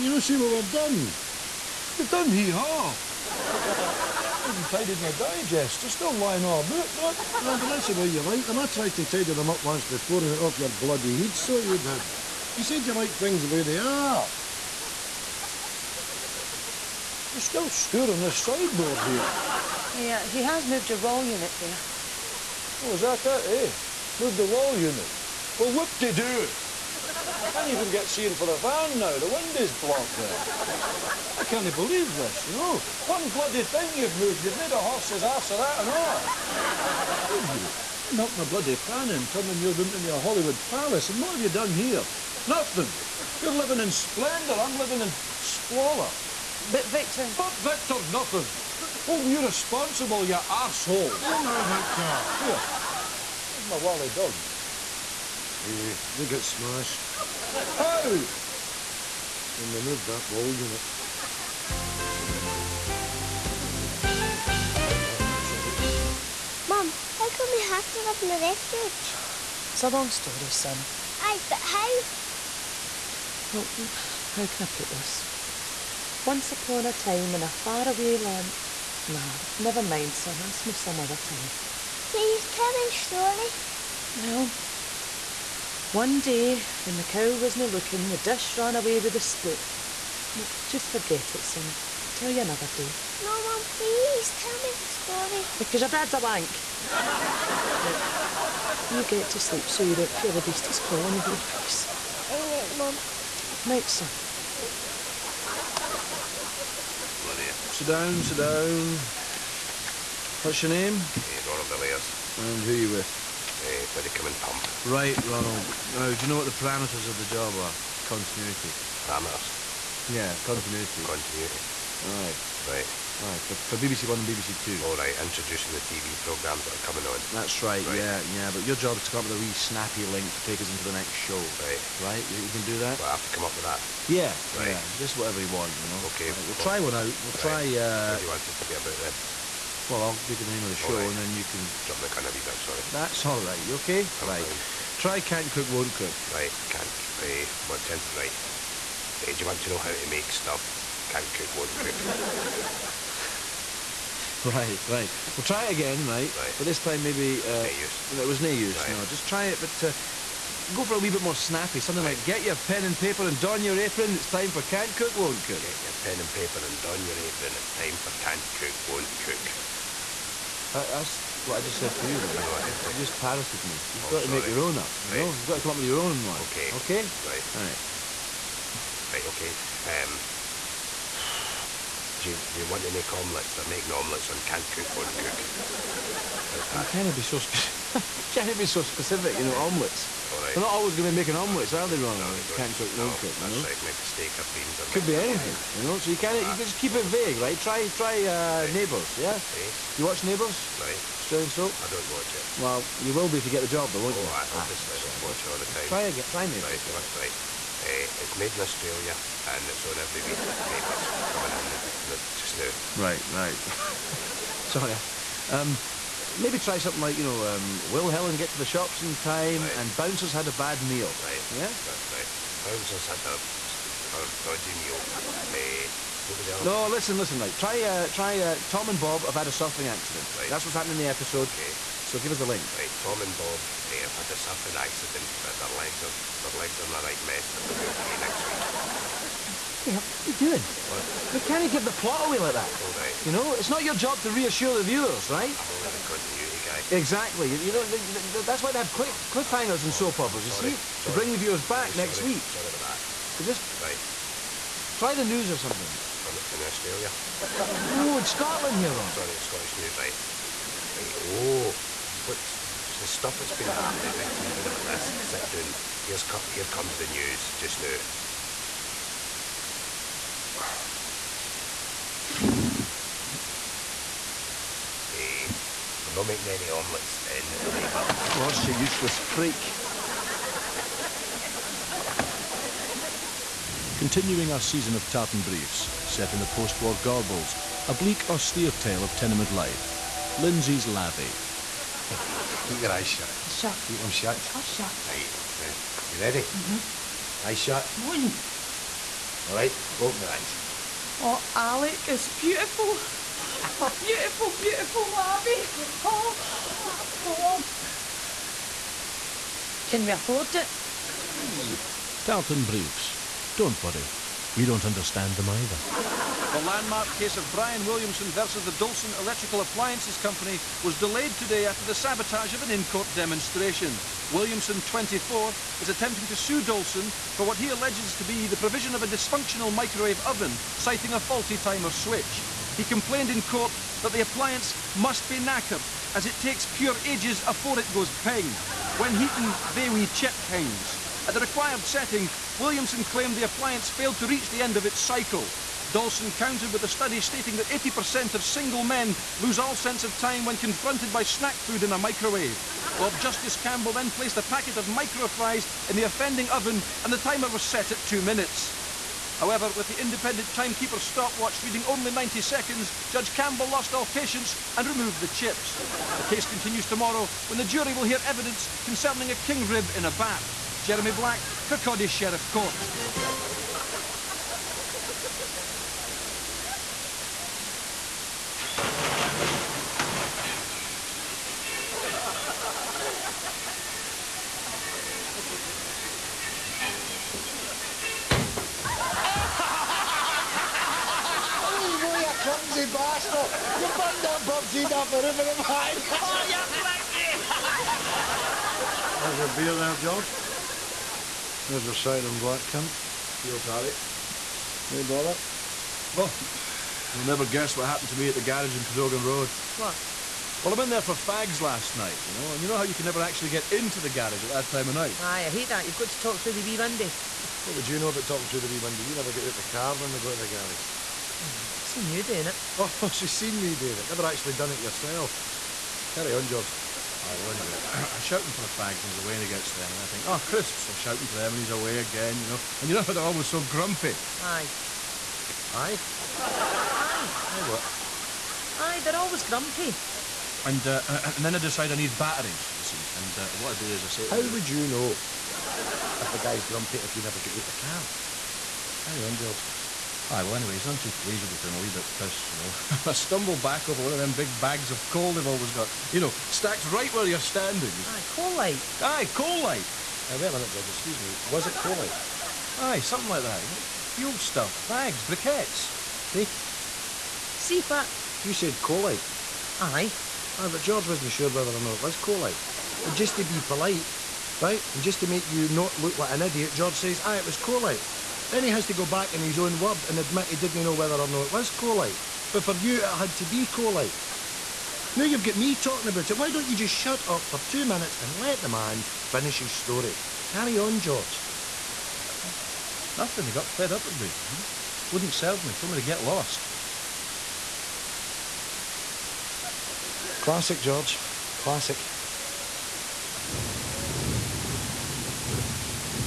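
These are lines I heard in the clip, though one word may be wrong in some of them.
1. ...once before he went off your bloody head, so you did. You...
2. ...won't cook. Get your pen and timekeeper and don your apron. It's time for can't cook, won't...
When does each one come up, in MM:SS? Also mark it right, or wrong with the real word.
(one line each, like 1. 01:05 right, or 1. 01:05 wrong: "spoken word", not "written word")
1. 00:09 right
2. 02:45 wrong: "paper", not "timekeeper".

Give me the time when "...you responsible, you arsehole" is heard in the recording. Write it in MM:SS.
00:49.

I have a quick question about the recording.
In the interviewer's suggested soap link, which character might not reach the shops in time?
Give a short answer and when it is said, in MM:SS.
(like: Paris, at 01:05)
Helen, at 03:38.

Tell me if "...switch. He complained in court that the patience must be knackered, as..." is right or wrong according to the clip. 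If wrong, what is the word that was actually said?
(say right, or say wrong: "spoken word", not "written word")
wrong: "appliance", not "patience".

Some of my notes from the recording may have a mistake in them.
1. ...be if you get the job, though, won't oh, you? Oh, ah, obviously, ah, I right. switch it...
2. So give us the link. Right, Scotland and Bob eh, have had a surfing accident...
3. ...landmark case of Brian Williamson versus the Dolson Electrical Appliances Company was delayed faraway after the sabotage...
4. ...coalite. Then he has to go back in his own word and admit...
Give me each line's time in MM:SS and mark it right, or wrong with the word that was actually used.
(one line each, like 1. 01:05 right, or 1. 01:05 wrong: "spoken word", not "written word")
1. 03:23 wrong: "watch", not "switch"
2. 03:52 wrong: "Tom", not "Scotland"
3. 05:16 wrong: "today", not "faraway"
4. 07:57 right.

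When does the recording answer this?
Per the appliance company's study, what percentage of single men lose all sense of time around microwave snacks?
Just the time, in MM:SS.
05:47.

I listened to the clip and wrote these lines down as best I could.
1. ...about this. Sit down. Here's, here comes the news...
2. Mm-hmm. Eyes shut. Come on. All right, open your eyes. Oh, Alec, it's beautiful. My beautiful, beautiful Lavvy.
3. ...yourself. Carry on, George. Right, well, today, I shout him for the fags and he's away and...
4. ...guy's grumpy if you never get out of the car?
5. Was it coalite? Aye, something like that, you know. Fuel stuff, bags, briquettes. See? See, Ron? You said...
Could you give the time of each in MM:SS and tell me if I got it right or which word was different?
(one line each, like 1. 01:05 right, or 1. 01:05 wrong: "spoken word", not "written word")
1. 04:24 right
2. 04:56 right
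3. 07:04 wrong: "anyway", not "today"
4. 07:26 right
5. 07:41 wrong: "Pat", not "Ron".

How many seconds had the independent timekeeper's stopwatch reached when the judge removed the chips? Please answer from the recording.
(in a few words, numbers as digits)
90 seconds.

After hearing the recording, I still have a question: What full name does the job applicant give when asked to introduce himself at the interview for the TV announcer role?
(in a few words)
Ronald Villiers.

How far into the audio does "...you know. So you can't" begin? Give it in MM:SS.
03:15.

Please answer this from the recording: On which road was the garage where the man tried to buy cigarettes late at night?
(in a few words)
Cadogan Road.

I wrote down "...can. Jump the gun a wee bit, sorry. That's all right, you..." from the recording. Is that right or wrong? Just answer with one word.
right.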